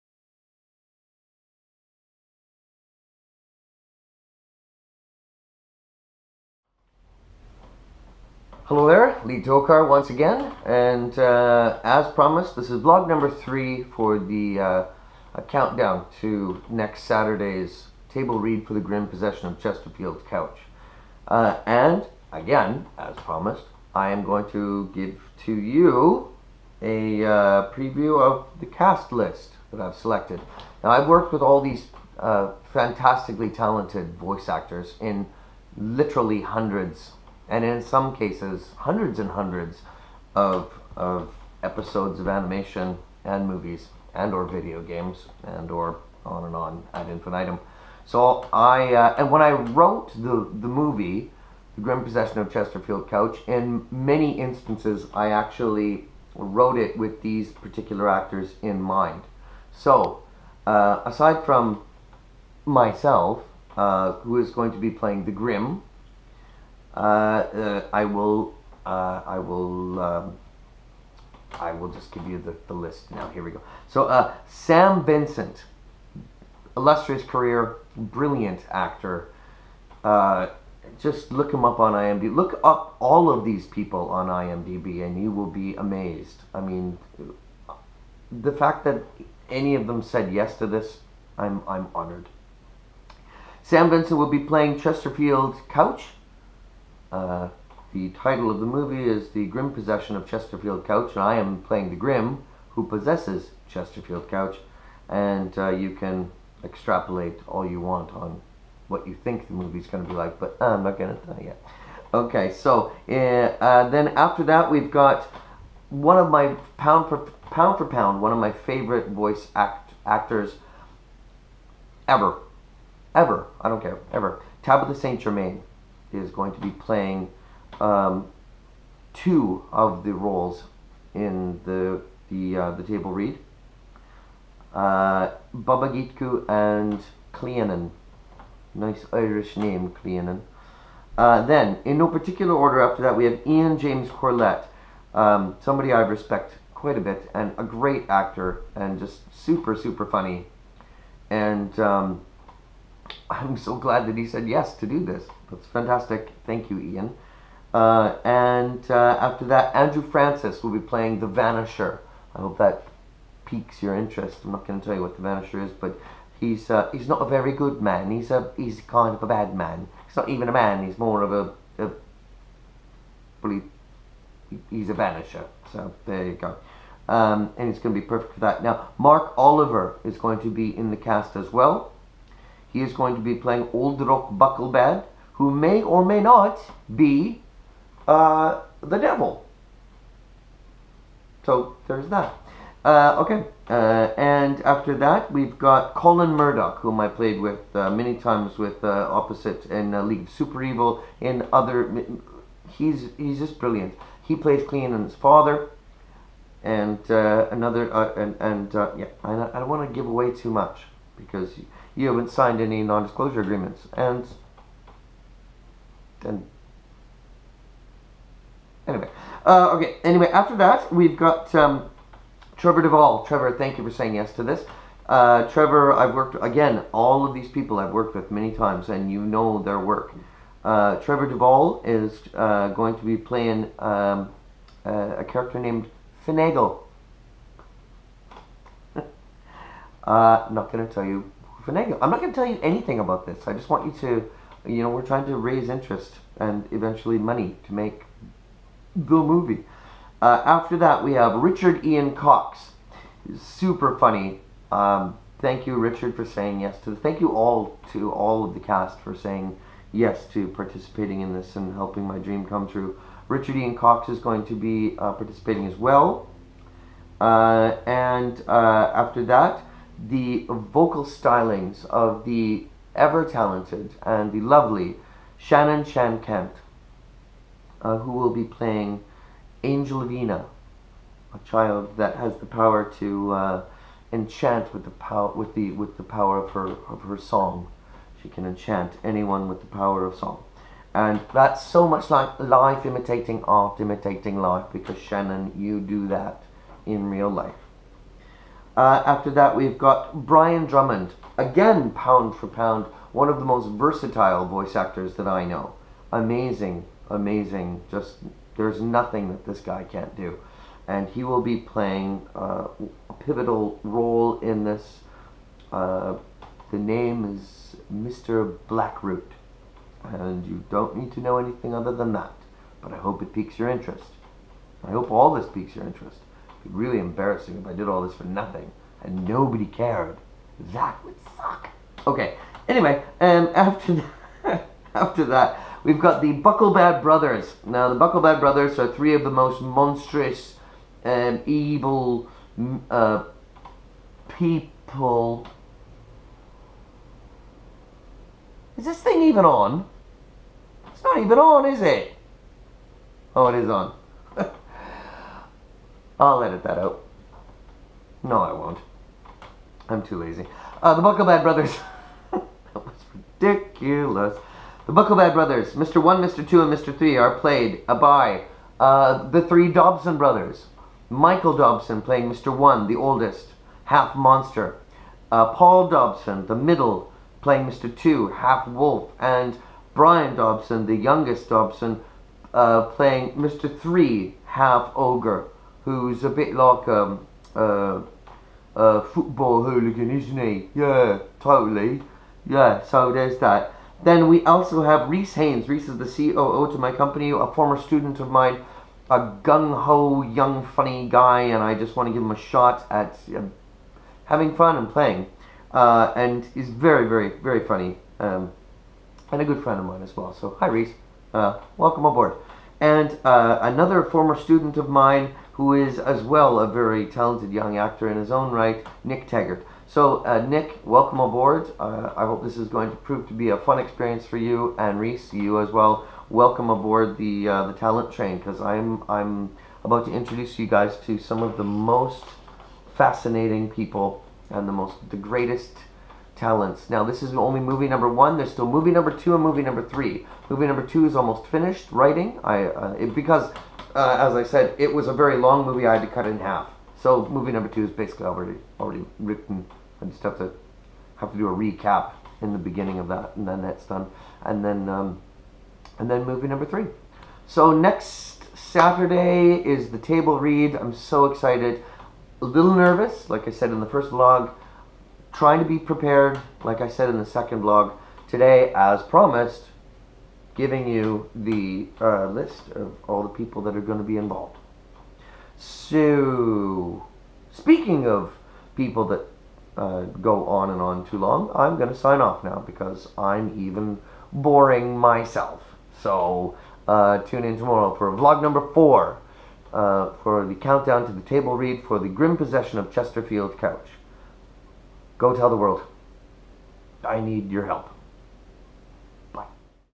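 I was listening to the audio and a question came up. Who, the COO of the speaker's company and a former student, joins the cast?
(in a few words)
Rees Haynes.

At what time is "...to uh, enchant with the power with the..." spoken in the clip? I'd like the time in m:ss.
4:42.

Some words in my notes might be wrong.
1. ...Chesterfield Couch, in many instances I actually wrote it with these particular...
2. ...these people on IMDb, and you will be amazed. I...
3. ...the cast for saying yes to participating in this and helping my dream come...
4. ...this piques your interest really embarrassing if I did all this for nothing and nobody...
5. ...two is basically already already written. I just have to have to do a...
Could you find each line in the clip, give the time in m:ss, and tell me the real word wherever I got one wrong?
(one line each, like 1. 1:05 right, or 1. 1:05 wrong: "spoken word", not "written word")
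1. 0:52 right
2. 1:23 right
3. 4:18 right
4. 5:25 right
5. 7:27 right.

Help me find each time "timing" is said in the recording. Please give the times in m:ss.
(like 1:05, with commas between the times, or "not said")
not said.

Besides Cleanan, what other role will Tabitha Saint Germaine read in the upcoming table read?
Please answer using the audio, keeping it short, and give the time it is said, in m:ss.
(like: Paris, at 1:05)
Baba Gitku, at 2:15.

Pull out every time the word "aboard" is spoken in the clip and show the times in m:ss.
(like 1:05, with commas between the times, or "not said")
6:52, 7:01, 7:06.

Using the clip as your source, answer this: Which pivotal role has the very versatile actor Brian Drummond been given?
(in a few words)
Mr. Blackroot.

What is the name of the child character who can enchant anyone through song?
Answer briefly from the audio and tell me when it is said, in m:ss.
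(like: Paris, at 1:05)
Angelina, at 4:39.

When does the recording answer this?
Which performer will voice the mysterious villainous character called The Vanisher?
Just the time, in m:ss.
2:39.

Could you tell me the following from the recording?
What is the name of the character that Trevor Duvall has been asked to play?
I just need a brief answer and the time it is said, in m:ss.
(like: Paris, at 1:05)
Finagle, at 3:56.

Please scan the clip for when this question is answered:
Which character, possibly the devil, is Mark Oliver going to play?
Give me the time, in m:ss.
3:03.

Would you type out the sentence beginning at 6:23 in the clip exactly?
3, half ogre who's a bit like um, uh, a football hooligan, isn't he?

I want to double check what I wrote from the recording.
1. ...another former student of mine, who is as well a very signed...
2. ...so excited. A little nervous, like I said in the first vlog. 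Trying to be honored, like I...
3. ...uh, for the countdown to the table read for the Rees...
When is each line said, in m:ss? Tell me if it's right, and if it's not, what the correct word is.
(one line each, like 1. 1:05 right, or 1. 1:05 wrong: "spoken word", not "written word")
1. 6:53 wrong: "talented", not "signed"
2. 7:40 wrong: "prepared", not "honored"
3. 8:09 wrong: "Grym", not "Rees".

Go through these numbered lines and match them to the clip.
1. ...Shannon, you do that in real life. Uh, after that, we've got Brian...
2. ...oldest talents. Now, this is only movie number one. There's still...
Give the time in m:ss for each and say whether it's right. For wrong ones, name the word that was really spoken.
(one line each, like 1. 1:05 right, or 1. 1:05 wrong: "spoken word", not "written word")
1. 4:54 right
2. 7:15 wrong: "greatest", not "oldest".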